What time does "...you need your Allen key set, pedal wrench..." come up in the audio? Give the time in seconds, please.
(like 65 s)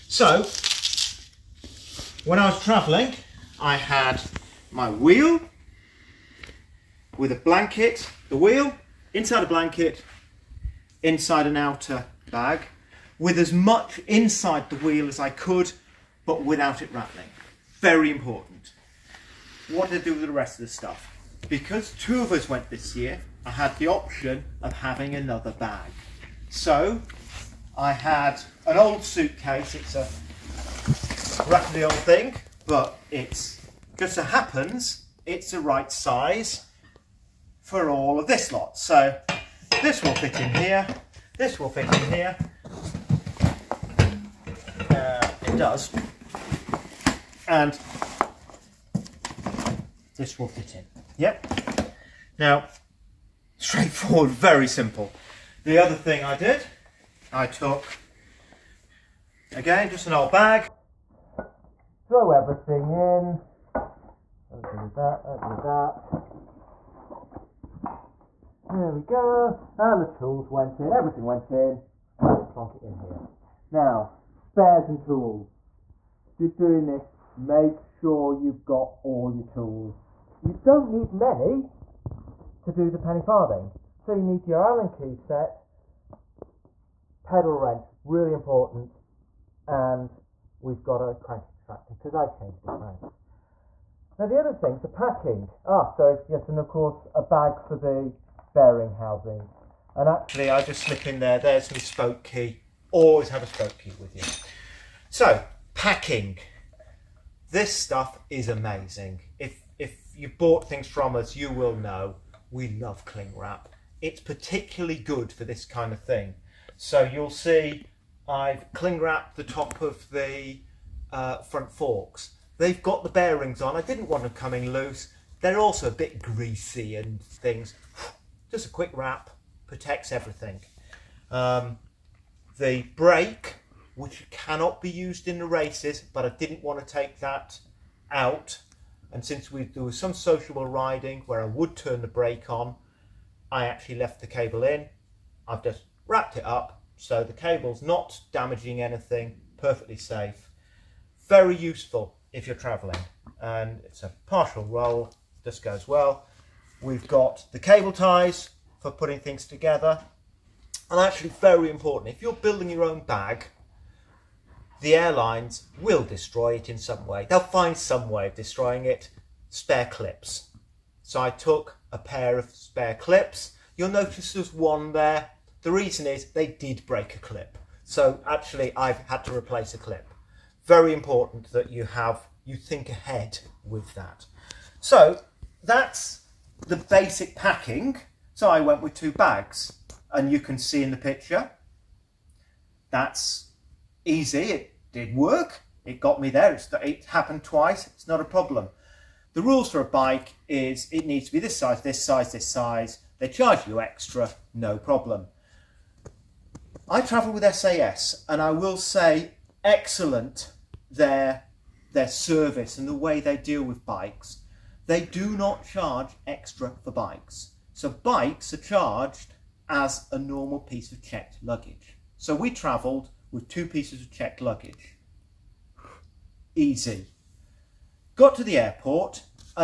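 84 s.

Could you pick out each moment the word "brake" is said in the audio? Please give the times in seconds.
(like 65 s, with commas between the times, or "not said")
132 s, 142 s.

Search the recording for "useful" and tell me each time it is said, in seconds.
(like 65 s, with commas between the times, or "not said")
151 s.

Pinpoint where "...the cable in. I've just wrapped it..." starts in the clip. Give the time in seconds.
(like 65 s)
144 s.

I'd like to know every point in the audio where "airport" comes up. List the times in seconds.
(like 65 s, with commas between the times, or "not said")
228 s.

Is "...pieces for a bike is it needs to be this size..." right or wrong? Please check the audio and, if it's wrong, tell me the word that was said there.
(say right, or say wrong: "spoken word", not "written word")
wrong: "rules", not "pieces".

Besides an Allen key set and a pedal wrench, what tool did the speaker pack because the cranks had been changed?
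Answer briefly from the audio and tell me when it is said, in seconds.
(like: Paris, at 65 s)
crank extractor, at 91 s.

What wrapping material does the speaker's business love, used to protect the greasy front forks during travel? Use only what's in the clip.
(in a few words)
cling wrap.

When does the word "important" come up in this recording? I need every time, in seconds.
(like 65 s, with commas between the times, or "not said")
18 s, 88 s, 161 s, 180 s.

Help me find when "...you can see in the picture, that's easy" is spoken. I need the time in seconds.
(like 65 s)
190 s.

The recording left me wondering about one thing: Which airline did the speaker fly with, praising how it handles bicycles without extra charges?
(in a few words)
SAS.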